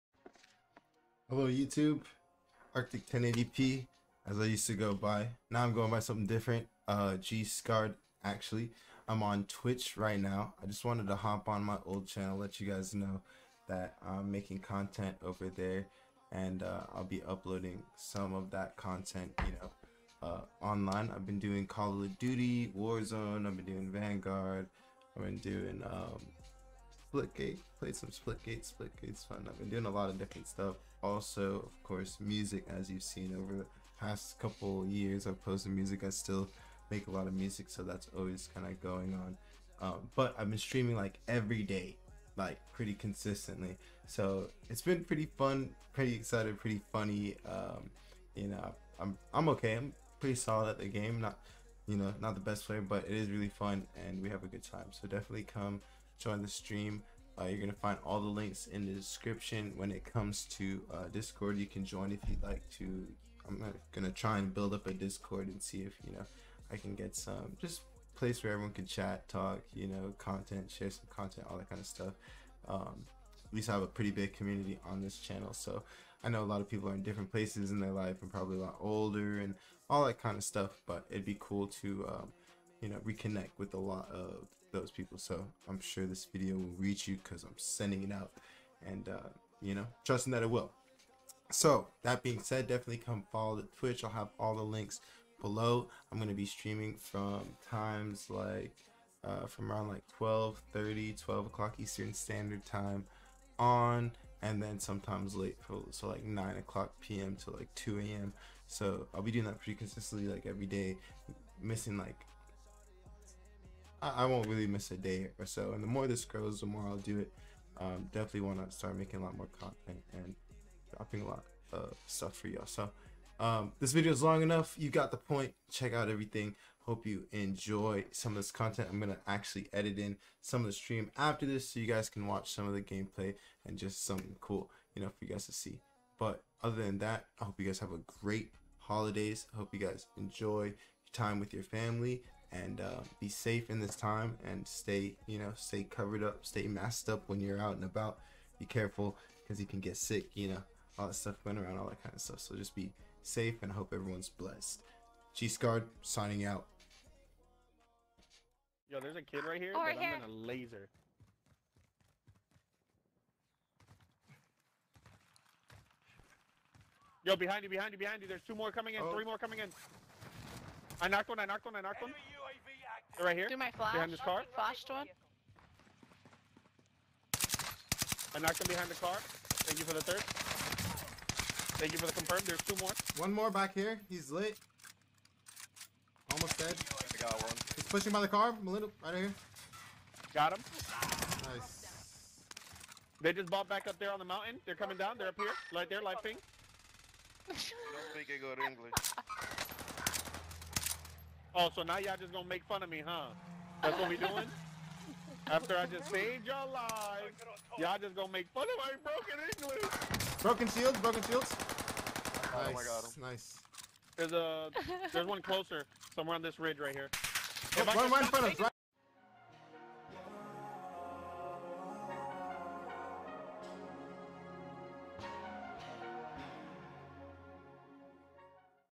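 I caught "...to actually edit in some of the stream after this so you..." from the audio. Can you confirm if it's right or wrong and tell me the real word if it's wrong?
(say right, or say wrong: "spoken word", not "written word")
right.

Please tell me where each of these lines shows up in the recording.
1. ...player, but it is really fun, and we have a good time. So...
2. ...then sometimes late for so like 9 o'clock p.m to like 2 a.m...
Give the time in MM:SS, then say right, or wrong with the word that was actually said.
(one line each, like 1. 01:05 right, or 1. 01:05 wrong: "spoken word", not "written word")
1. 00:52 right
2. 01:44 right.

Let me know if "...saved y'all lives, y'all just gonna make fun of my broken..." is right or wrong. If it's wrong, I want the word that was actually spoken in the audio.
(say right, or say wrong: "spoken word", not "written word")
right.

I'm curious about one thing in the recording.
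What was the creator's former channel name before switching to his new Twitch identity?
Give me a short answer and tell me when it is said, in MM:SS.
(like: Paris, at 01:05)
Arctic 1080p, at 00:02.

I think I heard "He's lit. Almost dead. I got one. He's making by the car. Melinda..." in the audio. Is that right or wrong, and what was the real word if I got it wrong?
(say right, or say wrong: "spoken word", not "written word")
wrong: "pushing", not "making".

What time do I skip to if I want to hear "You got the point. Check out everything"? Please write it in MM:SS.
02:04.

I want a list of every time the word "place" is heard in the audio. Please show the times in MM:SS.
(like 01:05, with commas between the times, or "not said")
01:08, 01:17.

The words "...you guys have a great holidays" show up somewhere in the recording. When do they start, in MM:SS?
02:17.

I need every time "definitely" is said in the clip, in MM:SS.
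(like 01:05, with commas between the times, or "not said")
00:55, 01:32, 01:58.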